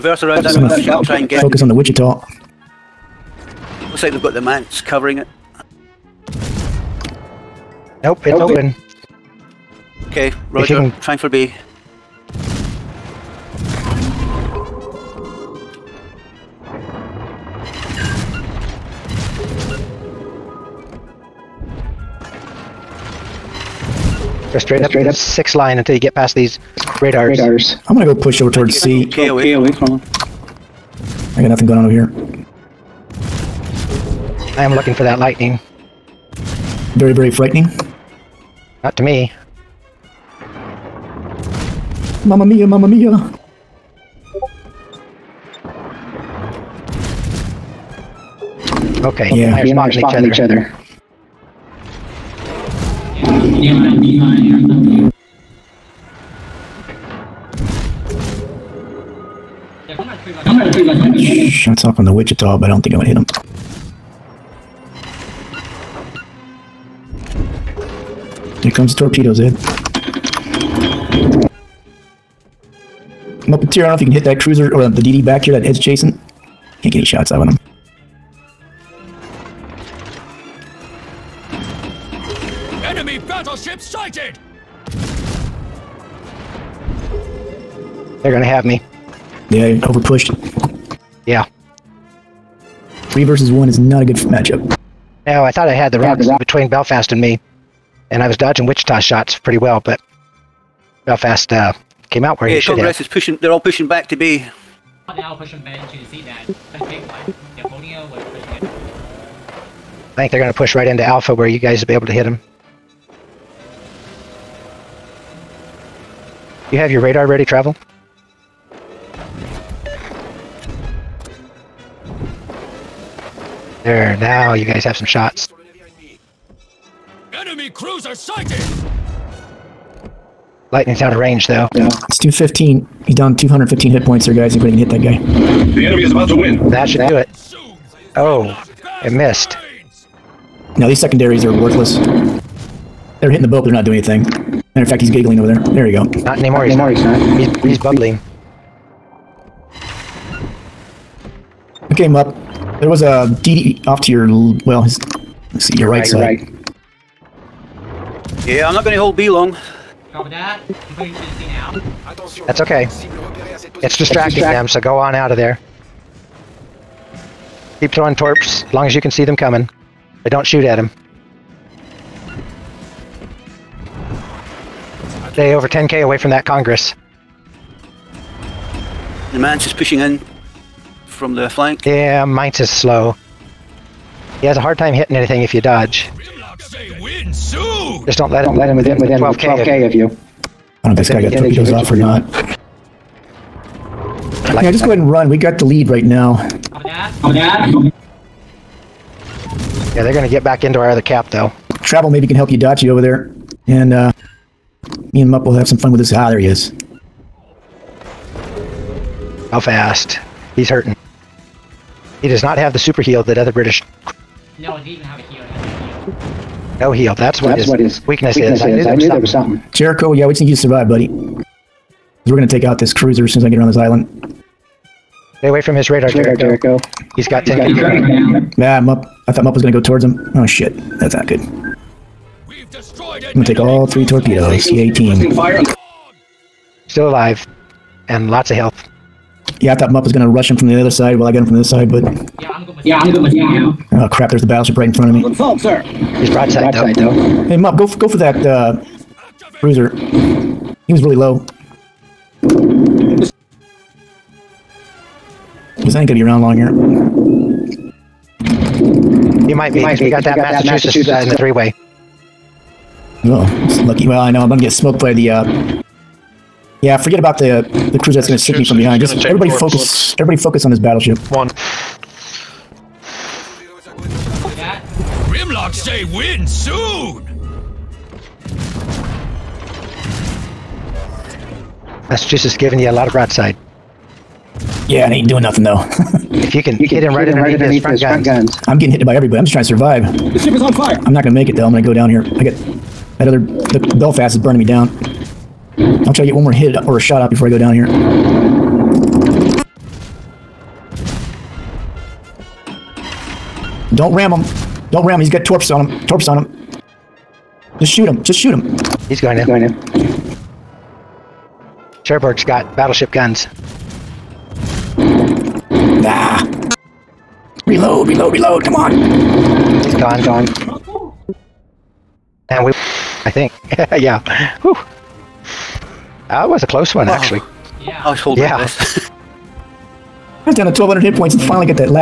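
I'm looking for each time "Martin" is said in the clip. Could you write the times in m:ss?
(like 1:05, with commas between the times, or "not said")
not said.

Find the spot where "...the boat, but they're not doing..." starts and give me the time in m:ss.
2:23.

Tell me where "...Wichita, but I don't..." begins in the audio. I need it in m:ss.
1:02.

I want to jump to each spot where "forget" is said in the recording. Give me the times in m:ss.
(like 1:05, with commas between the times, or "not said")
4:26.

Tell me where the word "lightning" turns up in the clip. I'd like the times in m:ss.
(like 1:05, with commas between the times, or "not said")
0:35, 2:10.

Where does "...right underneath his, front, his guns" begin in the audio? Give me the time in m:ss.
4:47.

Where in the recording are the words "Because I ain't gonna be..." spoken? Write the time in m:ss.
4:15.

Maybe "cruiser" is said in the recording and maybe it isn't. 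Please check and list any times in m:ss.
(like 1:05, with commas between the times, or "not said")
1:14, 2:07, 3:42, 4:27.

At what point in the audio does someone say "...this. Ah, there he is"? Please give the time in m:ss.
3:25.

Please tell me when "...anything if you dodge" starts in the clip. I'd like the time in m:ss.
3:05.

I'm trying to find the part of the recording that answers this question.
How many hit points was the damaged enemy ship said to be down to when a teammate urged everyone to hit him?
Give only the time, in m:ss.
2:13.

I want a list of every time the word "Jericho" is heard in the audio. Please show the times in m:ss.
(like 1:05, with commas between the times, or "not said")
3:39, 3:46.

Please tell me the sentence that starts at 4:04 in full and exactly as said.
There's the battleship right in front of me.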